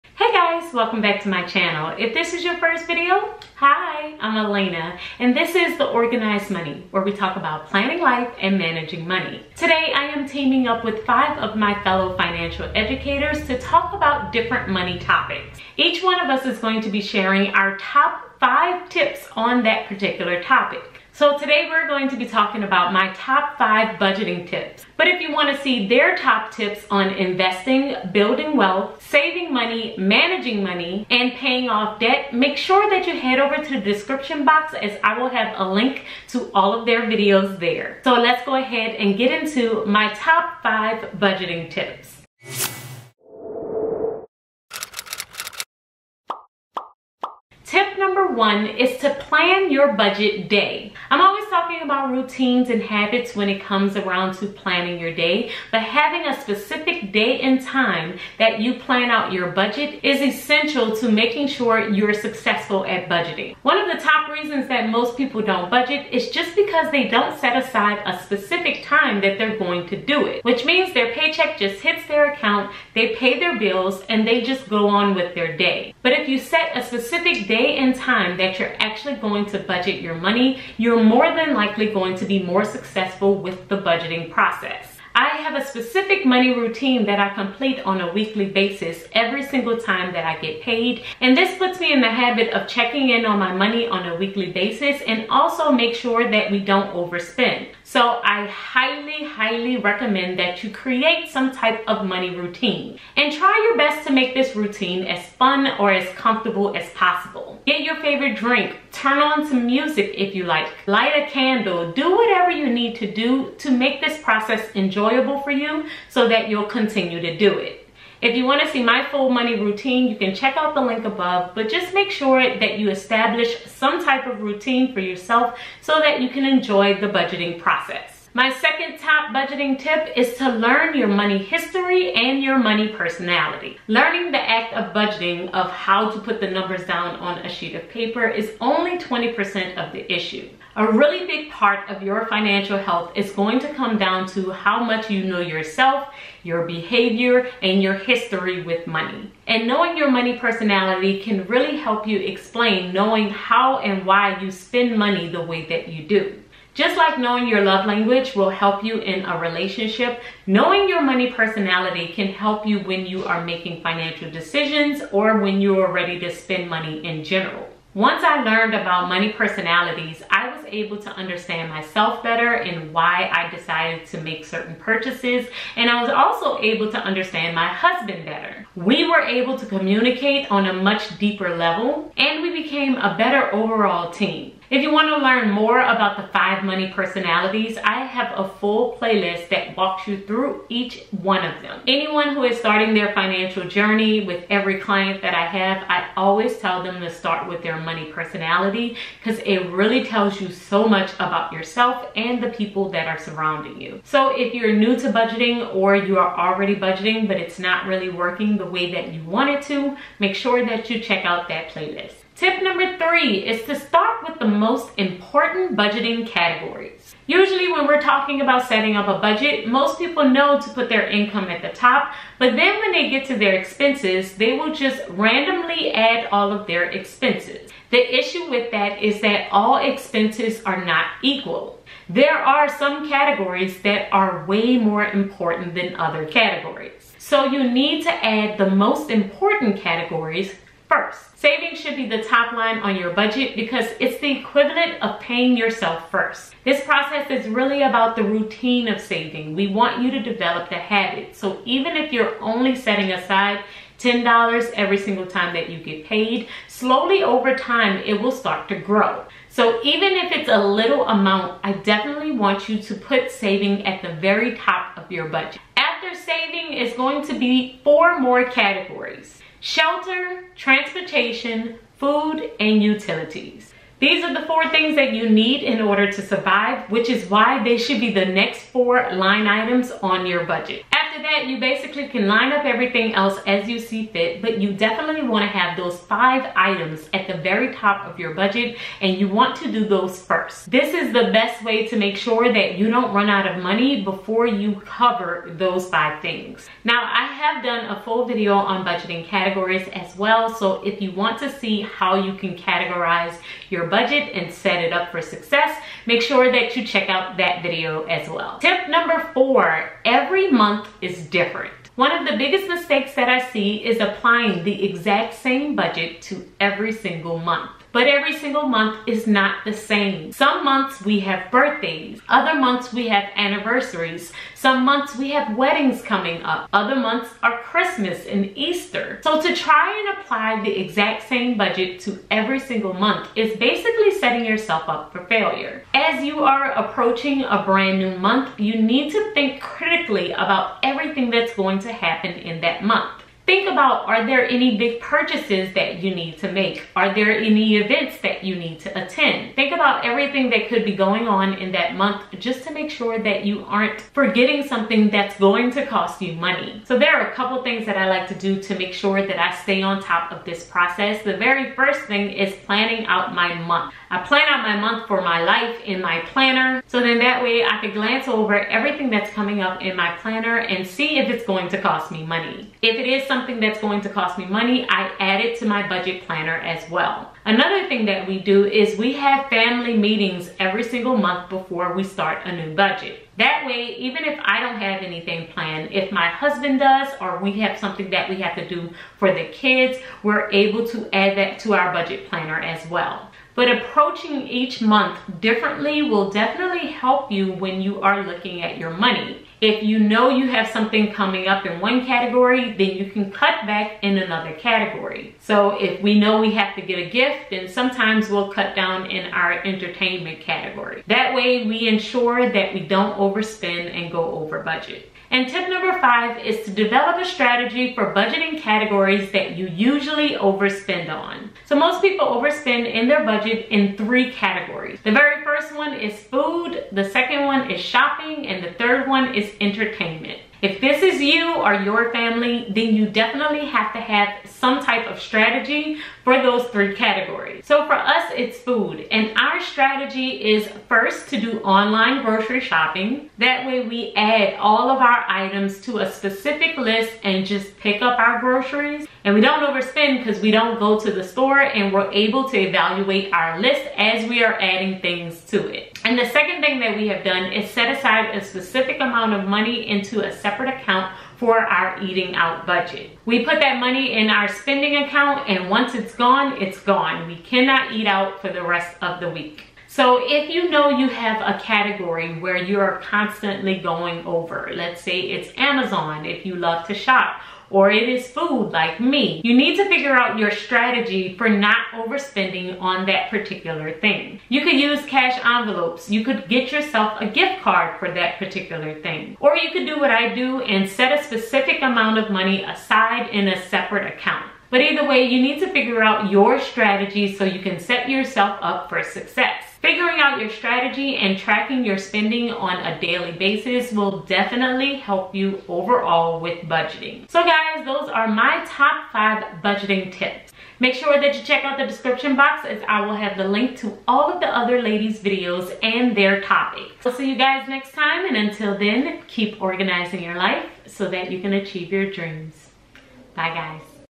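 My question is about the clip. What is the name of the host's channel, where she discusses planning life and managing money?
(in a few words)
The Organized Money.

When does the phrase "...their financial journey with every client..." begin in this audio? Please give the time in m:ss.
3:12.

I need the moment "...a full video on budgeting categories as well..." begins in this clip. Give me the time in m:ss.
4:57.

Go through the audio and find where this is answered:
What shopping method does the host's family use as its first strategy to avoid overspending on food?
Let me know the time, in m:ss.
7:21.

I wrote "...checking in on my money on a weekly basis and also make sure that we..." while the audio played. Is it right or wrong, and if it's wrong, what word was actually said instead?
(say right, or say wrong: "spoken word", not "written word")
right.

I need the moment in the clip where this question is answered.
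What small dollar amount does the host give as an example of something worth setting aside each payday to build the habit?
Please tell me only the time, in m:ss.
4:13.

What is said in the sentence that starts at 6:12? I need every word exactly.
If it is something that's going to cost me money, I add it to my budget planner as well.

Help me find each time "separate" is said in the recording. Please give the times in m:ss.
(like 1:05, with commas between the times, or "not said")
7:40, 8:13.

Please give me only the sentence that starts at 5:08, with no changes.
Tip number four, every month is different.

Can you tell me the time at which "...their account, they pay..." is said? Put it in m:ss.
1:12.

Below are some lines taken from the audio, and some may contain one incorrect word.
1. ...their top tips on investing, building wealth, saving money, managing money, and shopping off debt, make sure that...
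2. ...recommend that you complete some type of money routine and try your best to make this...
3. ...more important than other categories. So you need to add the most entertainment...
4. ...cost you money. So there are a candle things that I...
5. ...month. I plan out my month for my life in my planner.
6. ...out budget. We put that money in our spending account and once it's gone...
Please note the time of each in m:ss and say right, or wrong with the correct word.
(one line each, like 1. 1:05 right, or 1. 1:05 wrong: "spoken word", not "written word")
1. 0:25 wrong: "paying", not "shopping"
2. 1:39 wrong: "create", not "complete"
3. 3:54 wrong: "important", not "entertainment"
4. 5:55 wrong: "couple", not "candle"
5. 6:03 right
6. 7:42 right.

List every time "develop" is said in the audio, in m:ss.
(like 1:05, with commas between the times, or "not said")
4:10, 6:56.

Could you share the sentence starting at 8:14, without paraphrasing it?
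But either way, you need to figure out your strategy so you can set yourself up for success.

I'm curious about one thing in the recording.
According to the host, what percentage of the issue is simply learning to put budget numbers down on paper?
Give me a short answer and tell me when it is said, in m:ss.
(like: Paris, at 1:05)
20%, at 2:18.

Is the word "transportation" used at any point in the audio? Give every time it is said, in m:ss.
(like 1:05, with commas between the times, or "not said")
4:30.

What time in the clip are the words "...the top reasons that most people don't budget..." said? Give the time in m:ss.
1:03.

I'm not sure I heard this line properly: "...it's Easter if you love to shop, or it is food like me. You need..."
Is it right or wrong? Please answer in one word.
wrong.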